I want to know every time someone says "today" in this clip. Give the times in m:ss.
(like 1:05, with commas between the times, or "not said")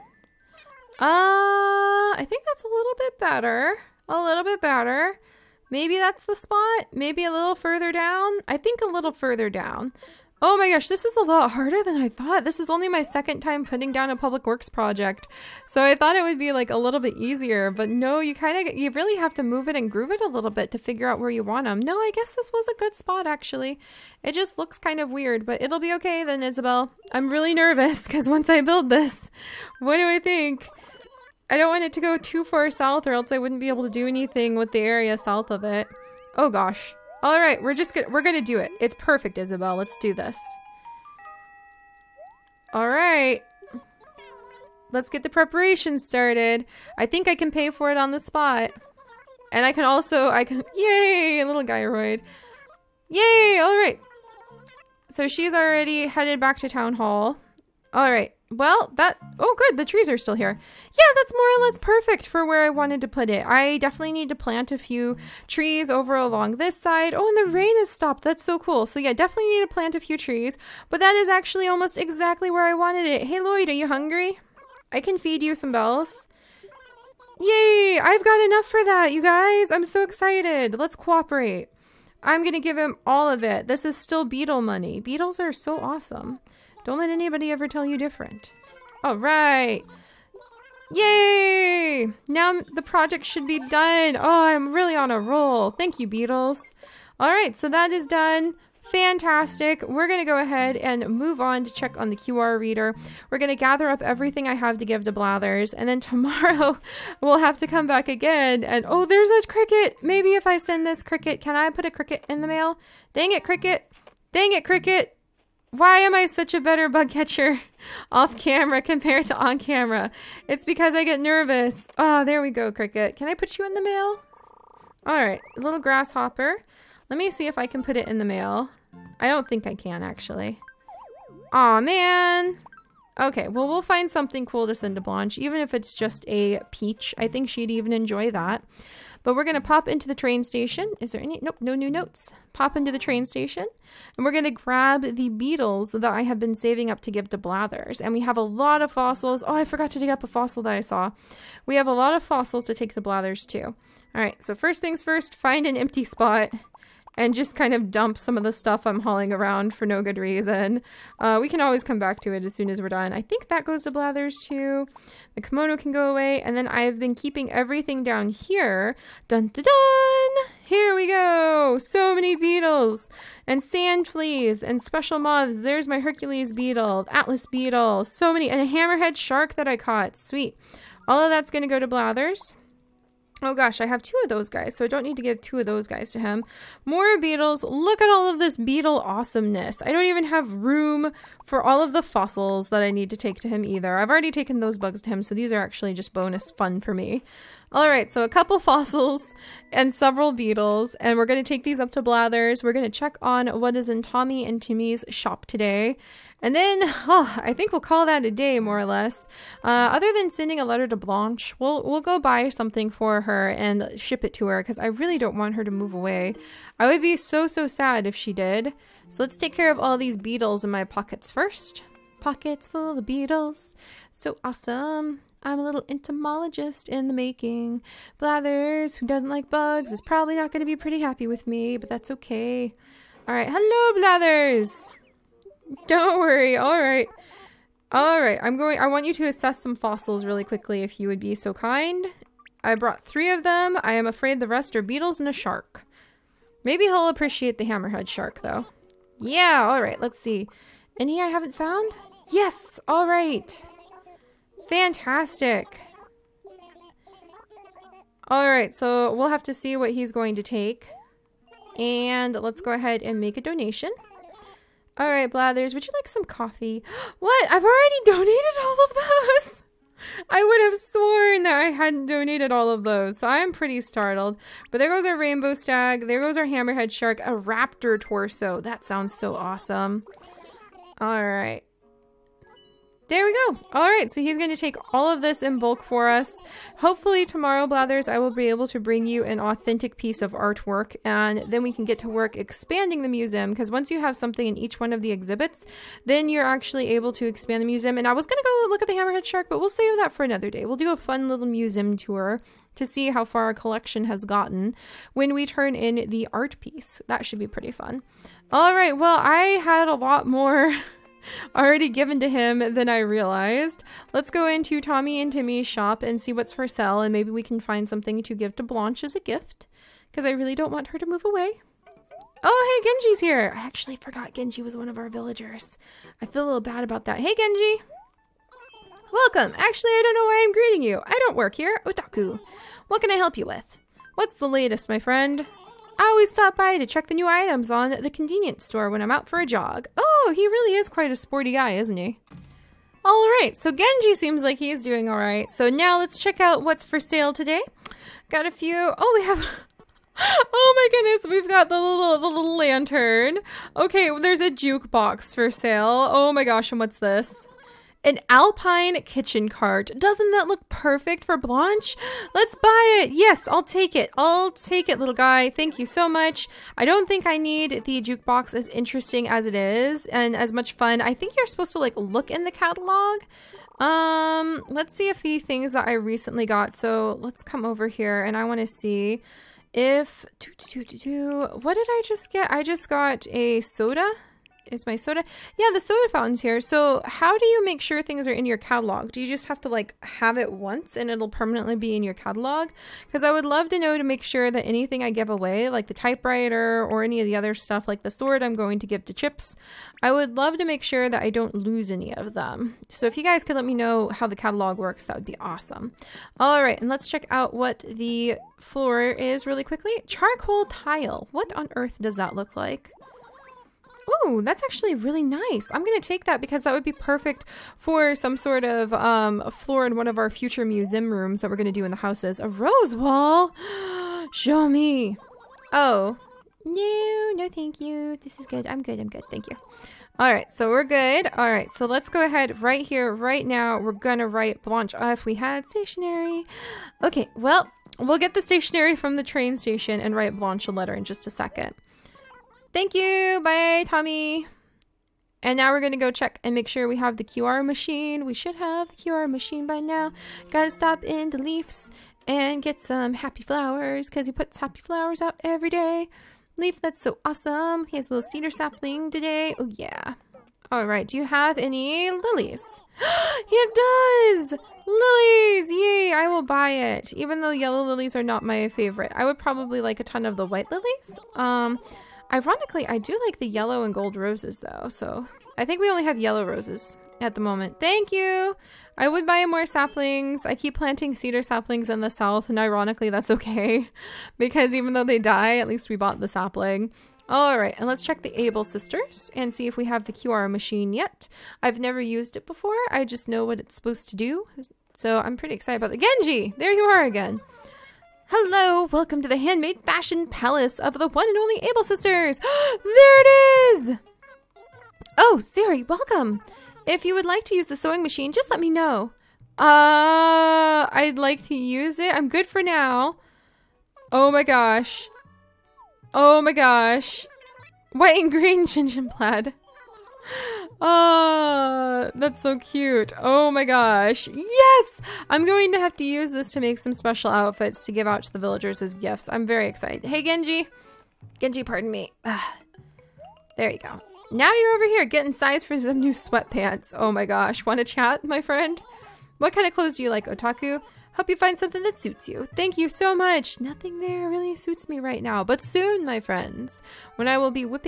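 3:25, 5:47, 7:39.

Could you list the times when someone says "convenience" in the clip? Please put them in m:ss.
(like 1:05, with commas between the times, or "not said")
5:38.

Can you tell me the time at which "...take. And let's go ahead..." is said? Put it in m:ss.
4:20.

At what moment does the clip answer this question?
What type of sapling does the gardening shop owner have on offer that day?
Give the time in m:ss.
7:38.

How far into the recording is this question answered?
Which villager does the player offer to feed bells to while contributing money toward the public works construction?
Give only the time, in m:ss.
1:13.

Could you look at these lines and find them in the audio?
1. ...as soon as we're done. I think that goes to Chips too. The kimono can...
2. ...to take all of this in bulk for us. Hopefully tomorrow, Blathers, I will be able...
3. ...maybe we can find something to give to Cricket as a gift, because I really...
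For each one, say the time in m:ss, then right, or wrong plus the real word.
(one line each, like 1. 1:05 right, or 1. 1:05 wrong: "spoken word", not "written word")
1. 2:42 wrong: "Blathers", not "Chips"
2. 4:44 right
3. 5:17 wrong: "Blanche", not "Cricket".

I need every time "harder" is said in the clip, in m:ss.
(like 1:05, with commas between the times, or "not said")
0:11.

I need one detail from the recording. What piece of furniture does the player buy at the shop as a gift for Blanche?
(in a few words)
Alpine kitchen cart.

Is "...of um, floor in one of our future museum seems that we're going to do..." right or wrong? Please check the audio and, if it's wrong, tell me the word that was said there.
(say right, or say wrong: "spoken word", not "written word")
wrong: "rooms", not "seems".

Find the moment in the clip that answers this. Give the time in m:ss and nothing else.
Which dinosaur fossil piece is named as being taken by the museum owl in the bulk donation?
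4:37.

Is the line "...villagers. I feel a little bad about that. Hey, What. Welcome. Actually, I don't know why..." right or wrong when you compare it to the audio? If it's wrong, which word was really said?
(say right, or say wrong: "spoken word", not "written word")
wrong: "Genji", not "What".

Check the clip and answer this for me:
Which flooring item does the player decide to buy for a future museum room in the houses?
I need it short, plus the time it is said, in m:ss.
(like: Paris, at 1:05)
Charcoal tile, at 6:50.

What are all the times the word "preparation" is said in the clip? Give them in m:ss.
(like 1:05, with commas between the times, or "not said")
0:45.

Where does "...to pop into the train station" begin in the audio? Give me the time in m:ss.
2:19.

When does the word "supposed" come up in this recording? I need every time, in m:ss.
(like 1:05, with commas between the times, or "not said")
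6:11, 8:13.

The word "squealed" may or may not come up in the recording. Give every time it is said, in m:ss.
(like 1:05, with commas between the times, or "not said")
not said.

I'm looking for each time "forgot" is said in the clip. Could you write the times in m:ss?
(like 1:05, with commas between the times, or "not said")
2:29, 5:23.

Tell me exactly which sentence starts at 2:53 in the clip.
And sand fleas and special moths.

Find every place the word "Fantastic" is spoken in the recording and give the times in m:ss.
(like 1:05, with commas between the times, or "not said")
1:38, 4:14.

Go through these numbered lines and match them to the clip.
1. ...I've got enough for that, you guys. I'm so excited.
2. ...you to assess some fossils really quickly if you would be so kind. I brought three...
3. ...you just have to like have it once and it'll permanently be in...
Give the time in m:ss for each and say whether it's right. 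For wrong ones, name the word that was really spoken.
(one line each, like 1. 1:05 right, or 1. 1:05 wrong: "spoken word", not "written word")
1. 1:18 right
2. 3:59 right
3. 6:29 right.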